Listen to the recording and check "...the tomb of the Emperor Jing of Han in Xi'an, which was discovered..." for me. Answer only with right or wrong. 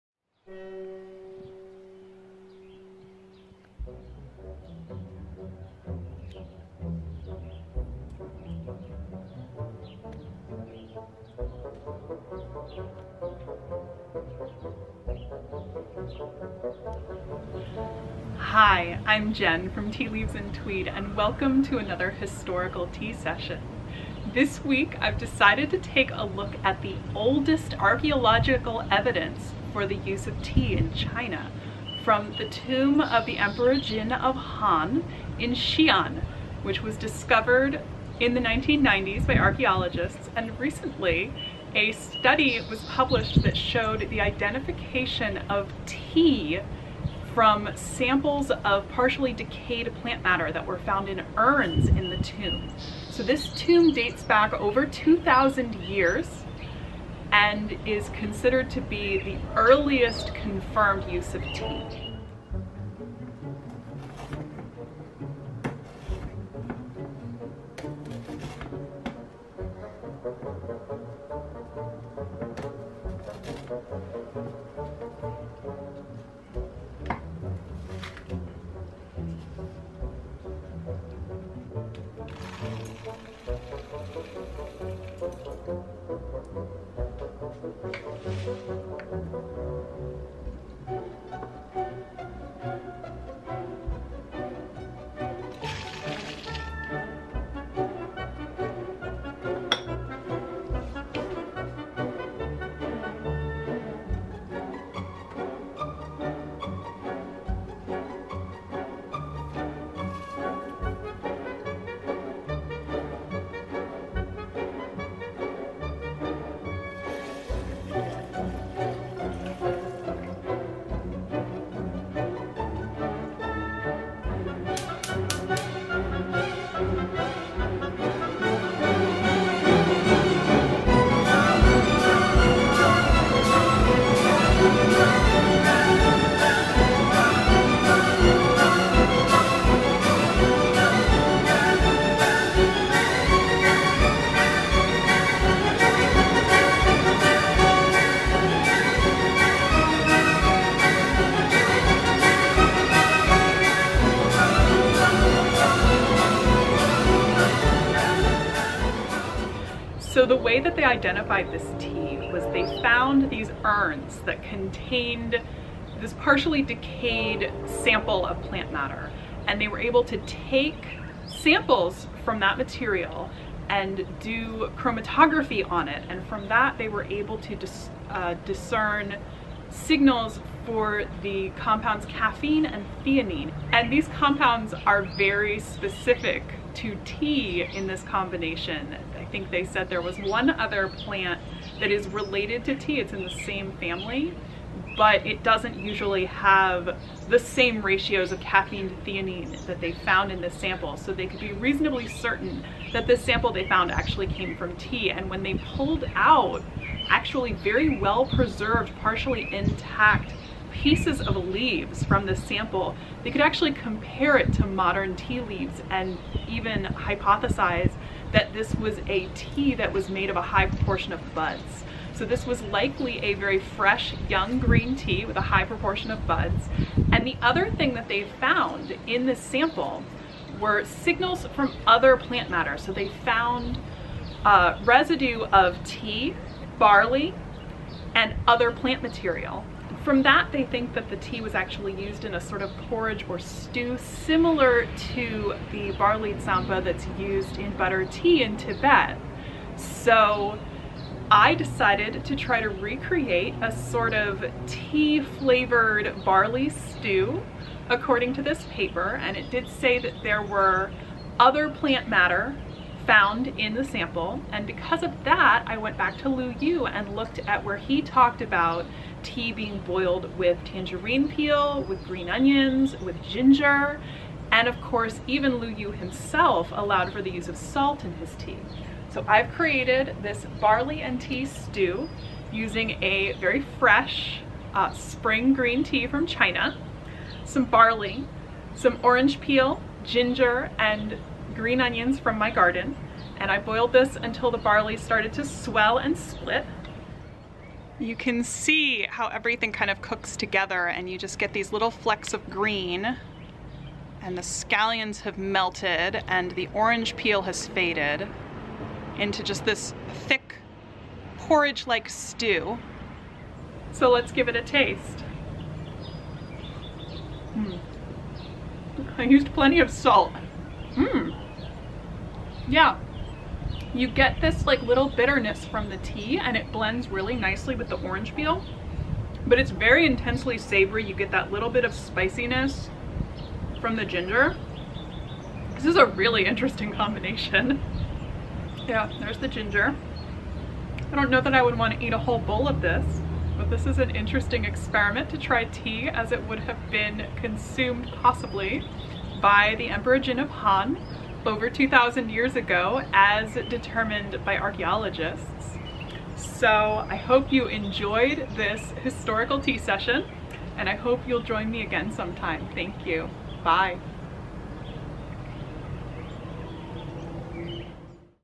right.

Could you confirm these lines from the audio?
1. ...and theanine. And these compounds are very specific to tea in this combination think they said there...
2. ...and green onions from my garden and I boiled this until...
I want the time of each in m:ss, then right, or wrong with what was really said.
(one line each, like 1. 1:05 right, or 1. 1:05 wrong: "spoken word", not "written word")
1. 3:02 right
2. 4:50 right.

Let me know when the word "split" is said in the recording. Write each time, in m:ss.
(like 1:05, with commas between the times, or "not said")
4:56.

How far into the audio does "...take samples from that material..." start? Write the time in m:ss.
2:50.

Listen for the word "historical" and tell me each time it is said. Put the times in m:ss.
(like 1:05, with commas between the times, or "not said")
0:22, 5:59.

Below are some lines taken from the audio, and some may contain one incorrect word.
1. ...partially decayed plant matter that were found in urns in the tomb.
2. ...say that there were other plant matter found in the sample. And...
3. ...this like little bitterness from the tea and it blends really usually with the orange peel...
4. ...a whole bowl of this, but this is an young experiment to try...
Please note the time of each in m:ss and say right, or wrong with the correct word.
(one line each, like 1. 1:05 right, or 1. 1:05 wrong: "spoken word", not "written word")
1. 0:48 right
2. 4:19 right
3. 5:24 wrong: "nicely", not "usually"
4. 5:42 wrong: "interesting", not "young".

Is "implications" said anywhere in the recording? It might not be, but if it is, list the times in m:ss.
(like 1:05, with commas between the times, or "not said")
not said.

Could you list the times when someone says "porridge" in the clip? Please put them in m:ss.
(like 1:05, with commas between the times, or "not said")
4:02, 5:11.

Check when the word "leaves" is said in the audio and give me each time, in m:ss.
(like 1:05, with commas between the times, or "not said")
0:20, 3:31, 3:35.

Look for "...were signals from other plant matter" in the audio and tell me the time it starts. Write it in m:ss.
3:50.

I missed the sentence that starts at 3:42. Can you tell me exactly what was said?
So this was likely a very fresh, young green tea with a high proportion of buds.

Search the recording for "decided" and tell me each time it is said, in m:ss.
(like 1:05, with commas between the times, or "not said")
0:25, 4:11.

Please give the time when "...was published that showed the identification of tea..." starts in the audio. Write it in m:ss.
0:42.